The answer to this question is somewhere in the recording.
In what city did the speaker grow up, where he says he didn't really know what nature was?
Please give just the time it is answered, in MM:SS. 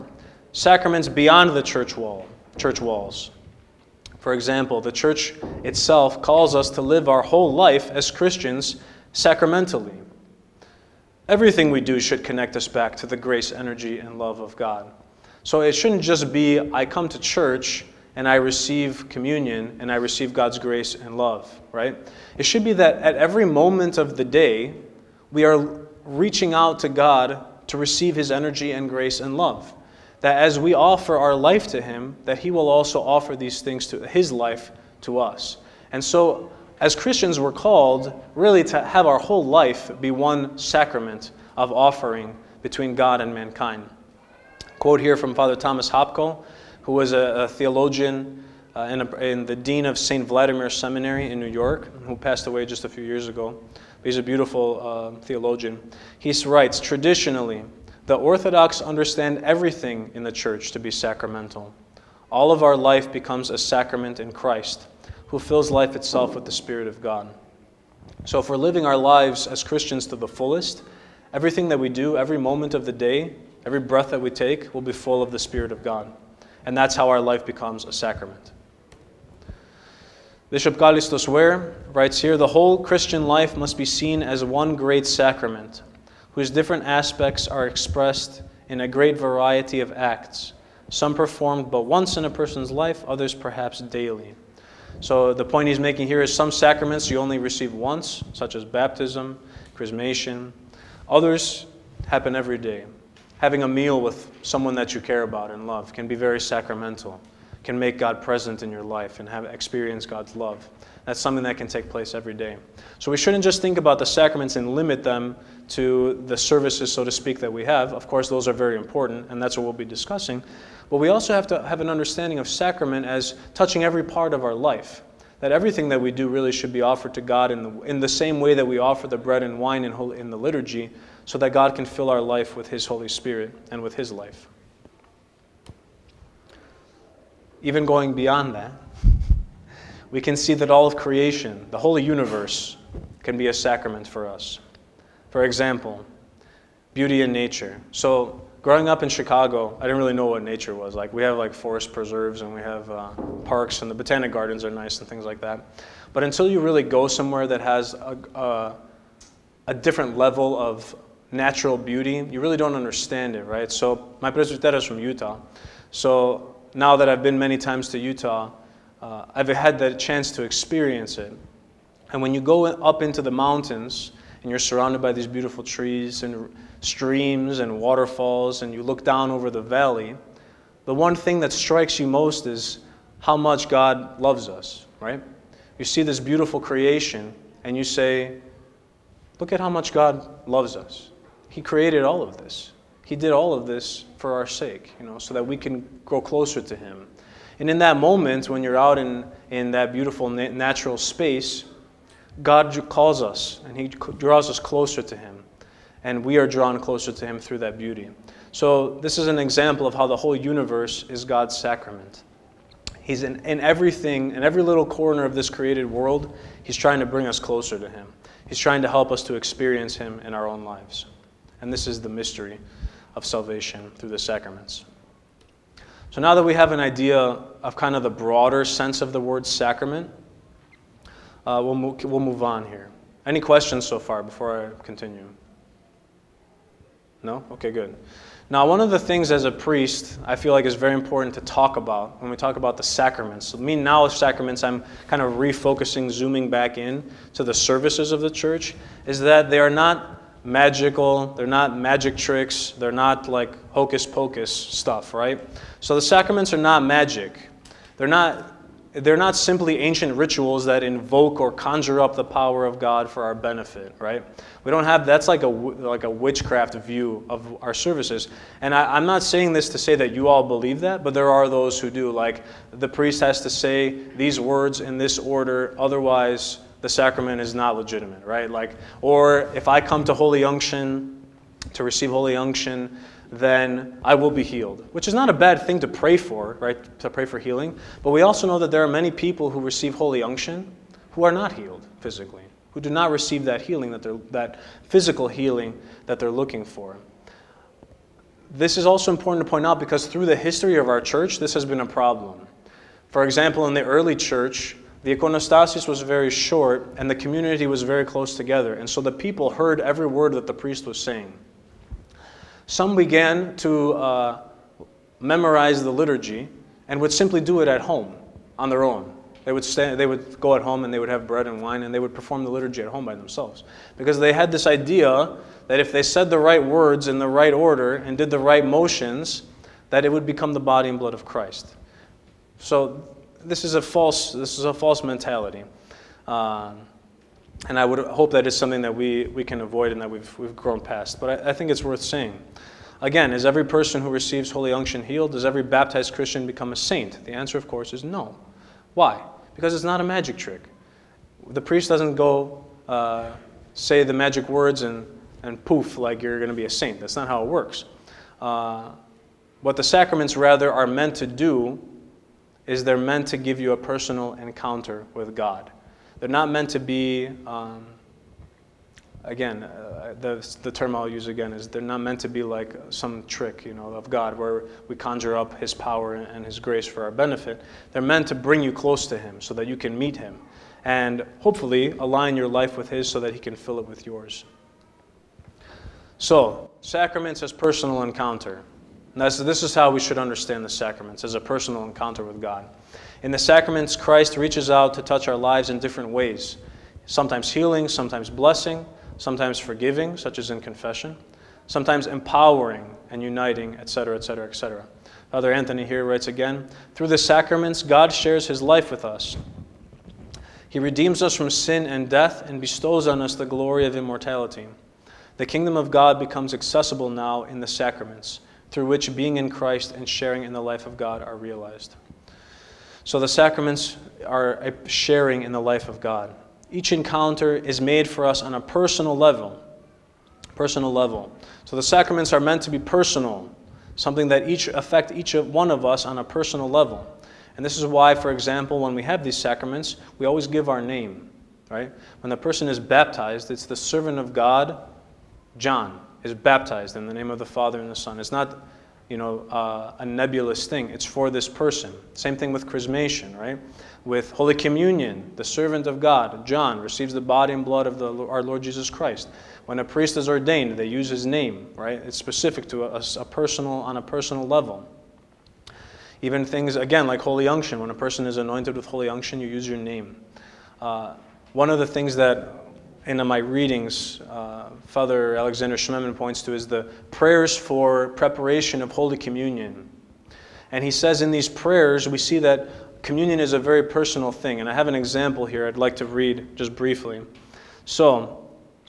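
02:29.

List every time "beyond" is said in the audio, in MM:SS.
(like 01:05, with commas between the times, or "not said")
00:01, 02:18.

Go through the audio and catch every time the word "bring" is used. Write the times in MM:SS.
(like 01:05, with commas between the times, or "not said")
03:37, 06:18.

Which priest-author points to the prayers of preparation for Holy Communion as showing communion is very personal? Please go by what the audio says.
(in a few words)
Alexander Schmemann.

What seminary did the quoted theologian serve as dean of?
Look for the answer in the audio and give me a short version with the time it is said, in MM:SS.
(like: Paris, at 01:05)
St. Vladimir Seminary, at 00:49.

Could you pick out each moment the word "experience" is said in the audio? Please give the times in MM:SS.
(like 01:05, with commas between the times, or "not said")
01:49, 02:50, 03:39.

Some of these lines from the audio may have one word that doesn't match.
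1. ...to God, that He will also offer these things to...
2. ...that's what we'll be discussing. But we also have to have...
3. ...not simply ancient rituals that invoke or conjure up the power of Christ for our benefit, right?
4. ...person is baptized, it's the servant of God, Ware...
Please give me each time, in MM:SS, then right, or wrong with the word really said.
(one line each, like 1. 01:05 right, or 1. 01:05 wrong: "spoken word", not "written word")
1. 00:31 wrong: "Him", not "God"
2. 01:59 right
3. 04:19 wrong: "God", not "Christ"
4. 07:22 wrong: "John", not "Ware".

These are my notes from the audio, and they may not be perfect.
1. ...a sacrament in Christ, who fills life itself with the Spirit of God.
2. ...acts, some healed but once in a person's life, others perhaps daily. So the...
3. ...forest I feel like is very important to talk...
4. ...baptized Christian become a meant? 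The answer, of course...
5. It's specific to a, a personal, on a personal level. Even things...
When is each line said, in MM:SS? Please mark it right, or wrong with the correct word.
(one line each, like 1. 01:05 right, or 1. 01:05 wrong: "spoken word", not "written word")
1. 01:03 right
2. 01:29 wrong: "performed", not "healed"
3. 03:59 wrong: "priest", not "forest"
4. 05:45 wrong: "saint", not "meant"
5. 07:42 right.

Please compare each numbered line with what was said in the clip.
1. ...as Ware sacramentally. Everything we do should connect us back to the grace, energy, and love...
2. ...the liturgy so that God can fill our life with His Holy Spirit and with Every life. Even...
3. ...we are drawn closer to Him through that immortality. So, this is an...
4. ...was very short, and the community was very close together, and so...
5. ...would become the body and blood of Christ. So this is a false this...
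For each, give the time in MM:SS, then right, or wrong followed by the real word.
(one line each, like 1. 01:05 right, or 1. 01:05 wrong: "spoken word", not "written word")
1. 00:07 wrong: "Christians", not "Ware"
2. 02:10 wrong: "His", not "Every"
3. 03:26 wrong: "beauty", not "immortality"
4. 05:05 right
5. 05:30 right.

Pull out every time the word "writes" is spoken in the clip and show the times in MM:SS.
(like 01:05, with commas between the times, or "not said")
00:56, 01:21, 06:46.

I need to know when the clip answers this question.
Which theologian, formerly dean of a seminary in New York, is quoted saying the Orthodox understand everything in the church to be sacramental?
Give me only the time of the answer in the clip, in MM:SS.
00:45.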